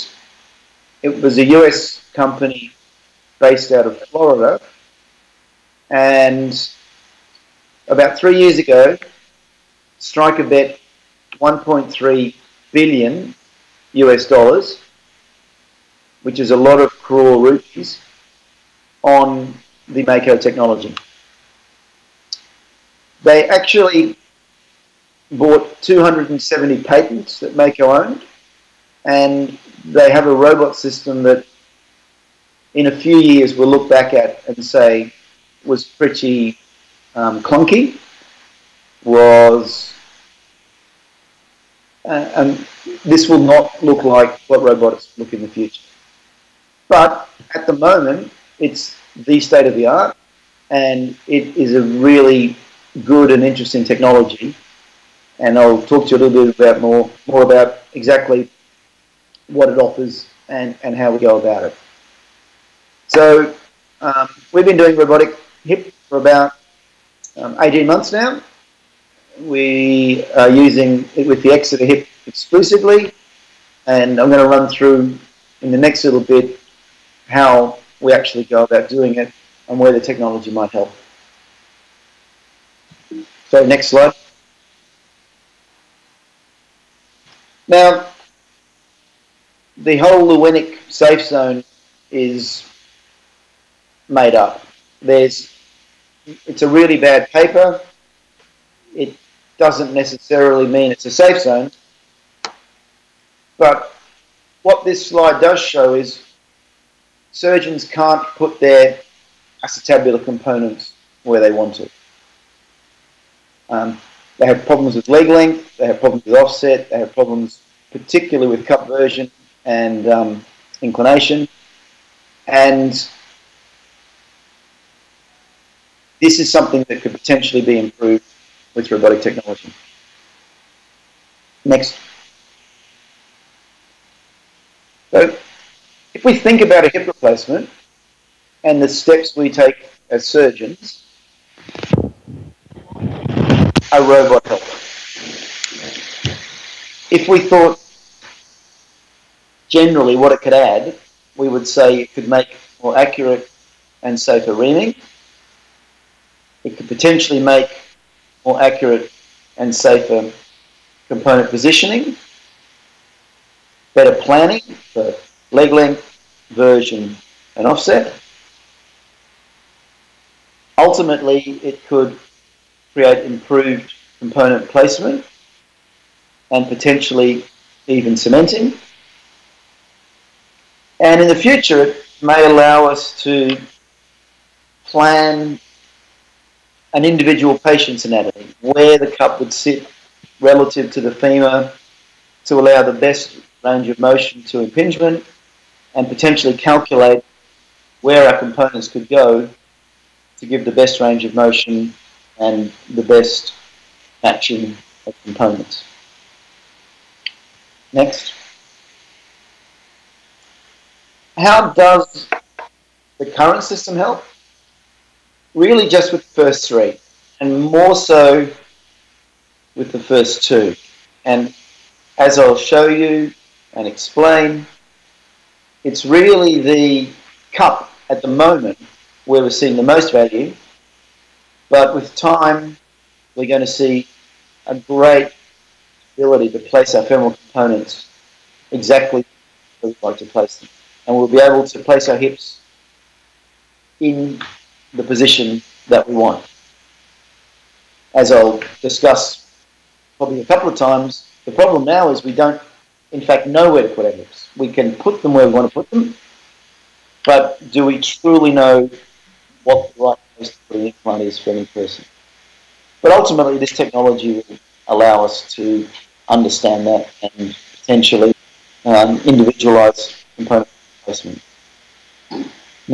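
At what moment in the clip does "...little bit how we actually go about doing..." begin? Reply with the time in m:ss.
1:16.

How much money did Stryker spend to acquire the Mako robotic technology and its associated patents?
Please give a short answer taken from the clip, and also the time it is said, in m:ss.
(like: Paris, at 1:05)
1.3 billion US dollars, at 0:11.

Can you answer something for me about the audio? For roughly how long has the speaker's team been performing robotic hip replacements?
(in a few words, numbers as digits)
18 months.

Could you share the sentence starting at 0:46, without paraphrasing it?
But at the moment, it's the state of the art, and it is a really good and interesting technology.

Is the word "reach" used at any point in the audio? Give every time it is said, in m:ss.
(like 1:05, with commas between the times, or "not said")
not said.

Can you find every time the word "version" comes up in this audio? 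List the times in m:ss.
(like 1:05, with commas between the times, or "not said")
1:58, 2:46.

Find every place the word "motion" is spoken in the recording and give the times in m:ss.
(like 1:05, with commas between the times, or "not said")
3:13, 3:21.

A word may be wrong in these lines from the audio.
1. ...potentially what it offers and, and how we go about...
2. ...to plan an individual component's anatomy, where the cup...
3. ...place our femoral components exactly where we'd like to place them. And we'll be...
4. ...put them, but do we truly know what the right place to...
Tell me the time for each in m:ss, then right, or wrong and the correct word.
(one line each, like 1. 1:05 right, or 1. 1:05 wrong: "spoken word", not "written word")
1. 0:57 wrong: "exactly", not "potentially"
2. 3:03 wrong: "patient", not "component"
3. 3:56 right
4. 4:15 right.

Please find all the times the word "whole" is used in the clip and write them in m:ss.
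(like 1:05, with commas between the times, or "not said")
1:29.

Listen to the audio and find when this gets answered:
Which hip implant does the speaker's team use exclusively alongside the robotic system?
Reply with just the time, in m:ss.
1:11.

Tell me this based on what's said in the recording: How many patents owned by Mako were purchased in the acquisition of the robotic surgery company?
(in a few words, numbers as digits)
270.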